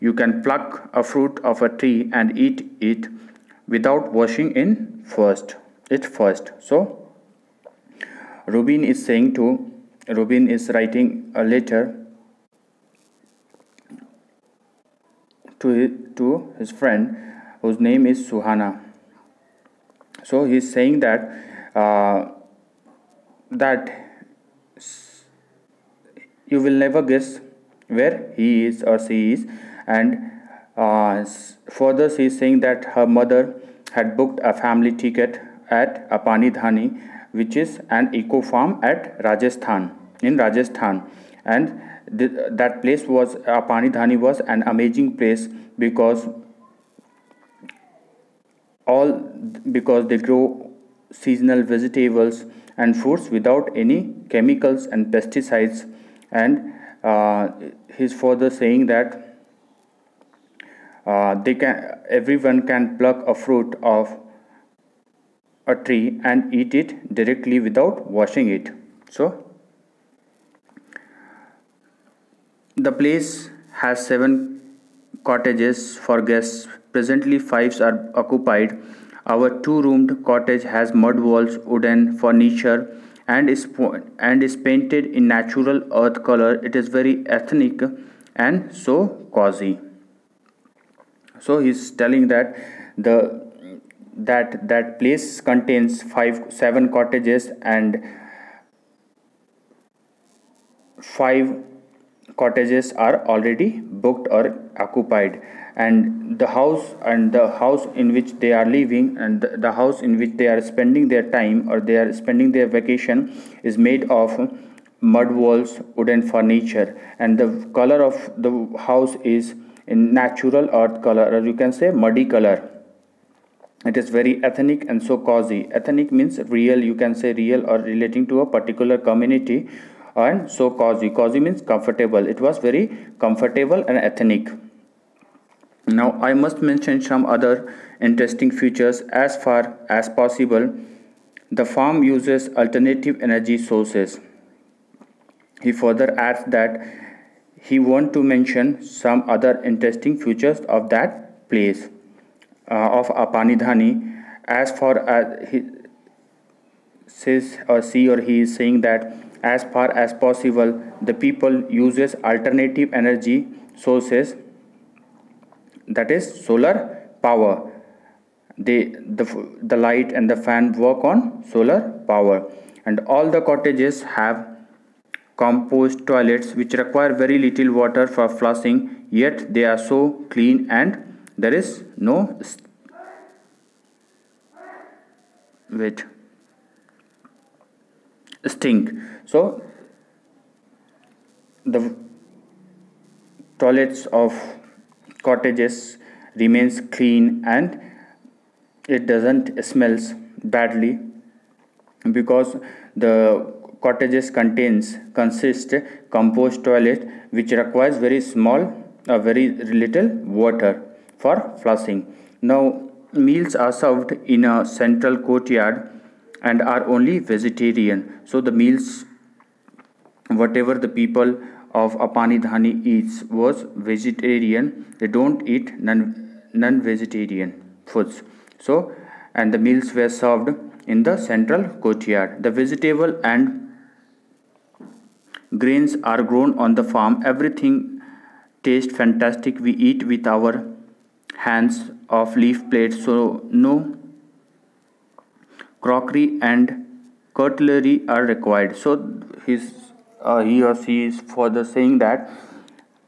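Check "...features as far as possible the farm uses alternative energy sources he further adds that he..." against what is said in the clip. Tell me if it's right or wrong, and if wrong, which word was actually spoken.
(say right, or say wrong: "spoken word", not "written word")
right.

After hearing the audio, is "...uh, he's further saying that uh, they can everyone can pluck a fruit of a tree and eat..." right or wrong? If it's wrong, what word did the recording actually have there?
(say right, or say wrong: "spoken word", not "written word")
right.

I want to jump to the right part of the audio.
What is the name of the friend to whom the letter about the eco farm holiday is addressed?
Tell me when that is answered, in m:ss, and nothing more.
0:18.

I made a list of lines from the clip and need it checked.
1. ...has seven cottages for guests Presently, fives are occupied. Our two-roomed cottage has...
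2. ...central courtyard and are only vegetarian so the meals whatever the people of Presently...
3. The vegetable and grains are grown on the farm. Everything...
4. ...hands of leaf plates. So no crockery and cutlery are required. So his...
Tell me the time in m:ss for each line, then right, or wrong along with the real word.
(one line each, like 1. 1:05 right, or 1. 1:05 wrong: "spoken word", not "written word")
1. 1:13 right
2. 3:34 wrong: "Apani", not "Presently"
3. 3:52 right
4. 4:01 right.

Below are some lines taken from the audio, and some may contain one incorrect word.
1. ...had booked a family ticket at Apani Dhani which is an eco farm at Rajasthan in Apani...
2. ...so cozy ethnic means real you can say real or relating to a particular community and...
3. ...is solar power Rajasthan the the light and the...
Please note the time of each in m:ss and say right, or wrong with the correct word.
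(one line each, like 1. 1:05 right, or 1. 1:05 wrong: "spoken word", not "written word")
1. 0:33 wrong: "Rajasthan", not "Apani"
2. 2:05 right
3. 2:46 wrong: "The", not "Rajasthan".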